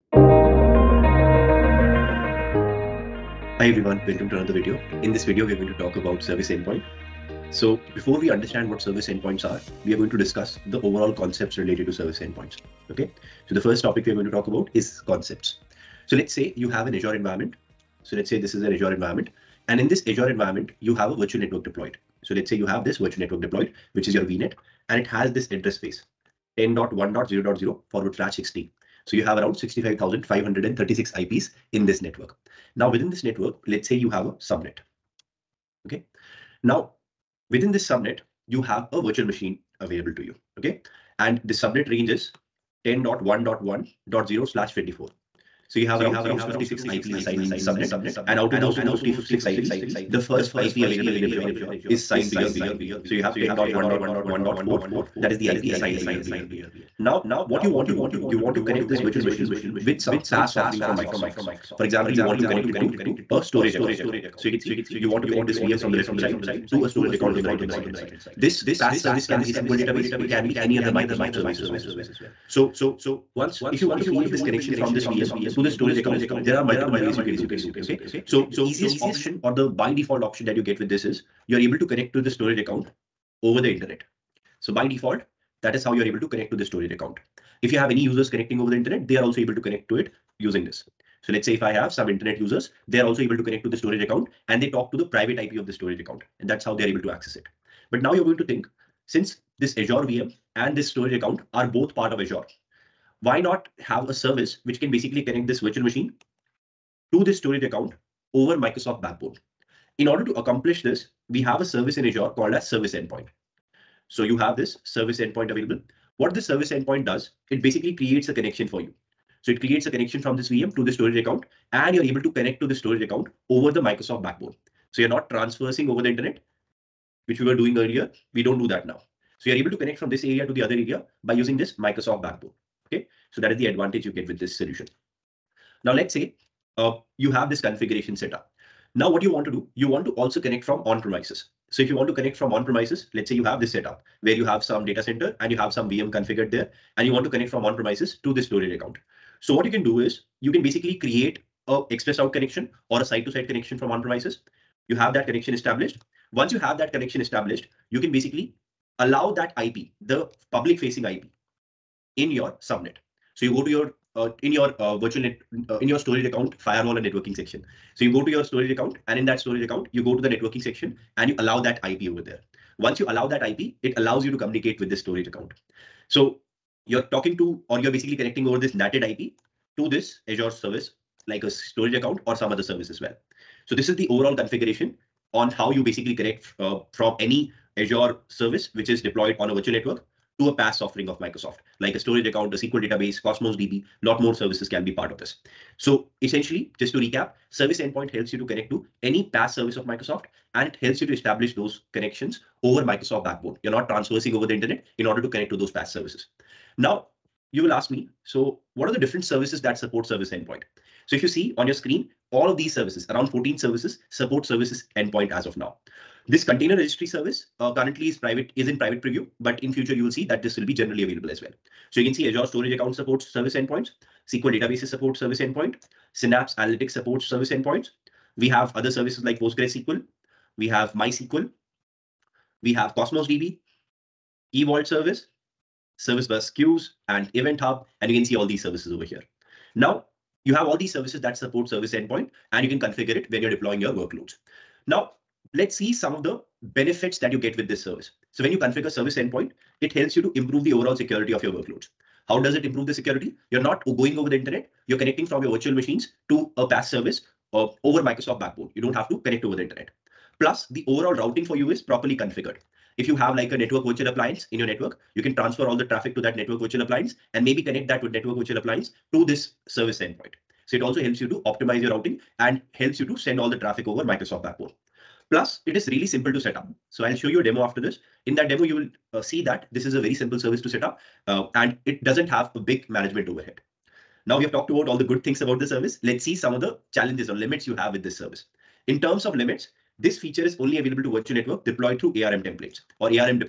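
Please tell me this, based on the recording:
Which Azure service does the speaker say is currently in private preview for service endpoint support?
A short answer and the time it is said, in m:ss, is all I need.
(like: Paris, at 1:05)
container registry, at 3:36.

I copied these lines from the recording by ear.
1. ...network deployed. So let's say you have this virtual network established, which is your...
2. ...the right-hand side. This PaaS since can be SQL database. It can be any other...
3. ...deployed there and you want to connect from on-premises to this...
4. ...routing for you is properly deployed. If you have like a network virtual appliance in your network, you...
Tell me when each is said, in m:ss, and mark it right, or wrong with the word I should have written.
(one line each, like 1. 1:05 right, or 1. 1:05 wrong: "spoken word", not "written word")
1. 0:21 wrong: "deployed", not "established"
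2. 1:07 wrong: "service", not "since"
3. 2:26 wrong: "configured", not "deployed"
4. 4:21 wrong: "configured", not "deployed".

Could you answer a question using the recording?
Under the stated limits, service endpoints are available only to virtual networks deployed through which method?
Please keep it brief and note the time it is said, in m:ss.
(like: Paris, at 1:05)
ARM templates, at 4:52.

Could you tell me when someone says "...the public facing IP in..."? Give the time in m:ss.
2:40.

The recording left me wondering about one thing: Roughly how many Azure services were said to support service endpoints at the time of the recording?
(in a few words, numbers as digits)
14.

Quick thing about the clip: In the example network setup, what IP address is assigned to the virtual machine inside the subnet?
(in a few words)
10.1.1.4.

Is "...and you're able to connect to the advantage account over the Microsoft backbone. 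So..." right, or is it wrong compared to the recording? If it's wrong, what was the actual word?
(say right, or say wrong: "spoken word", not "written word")
wrong: "storage", not "advantage".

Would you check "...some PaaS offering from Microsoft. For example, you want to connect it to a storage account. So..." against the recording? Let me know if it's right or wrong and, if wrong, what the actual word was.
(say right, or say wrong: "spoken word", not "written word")
right.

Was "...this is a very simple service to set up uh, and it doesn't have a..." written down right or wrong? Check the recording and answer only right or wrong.
right.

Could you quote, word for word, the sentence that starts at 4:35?
Plus, it is really simple to set up.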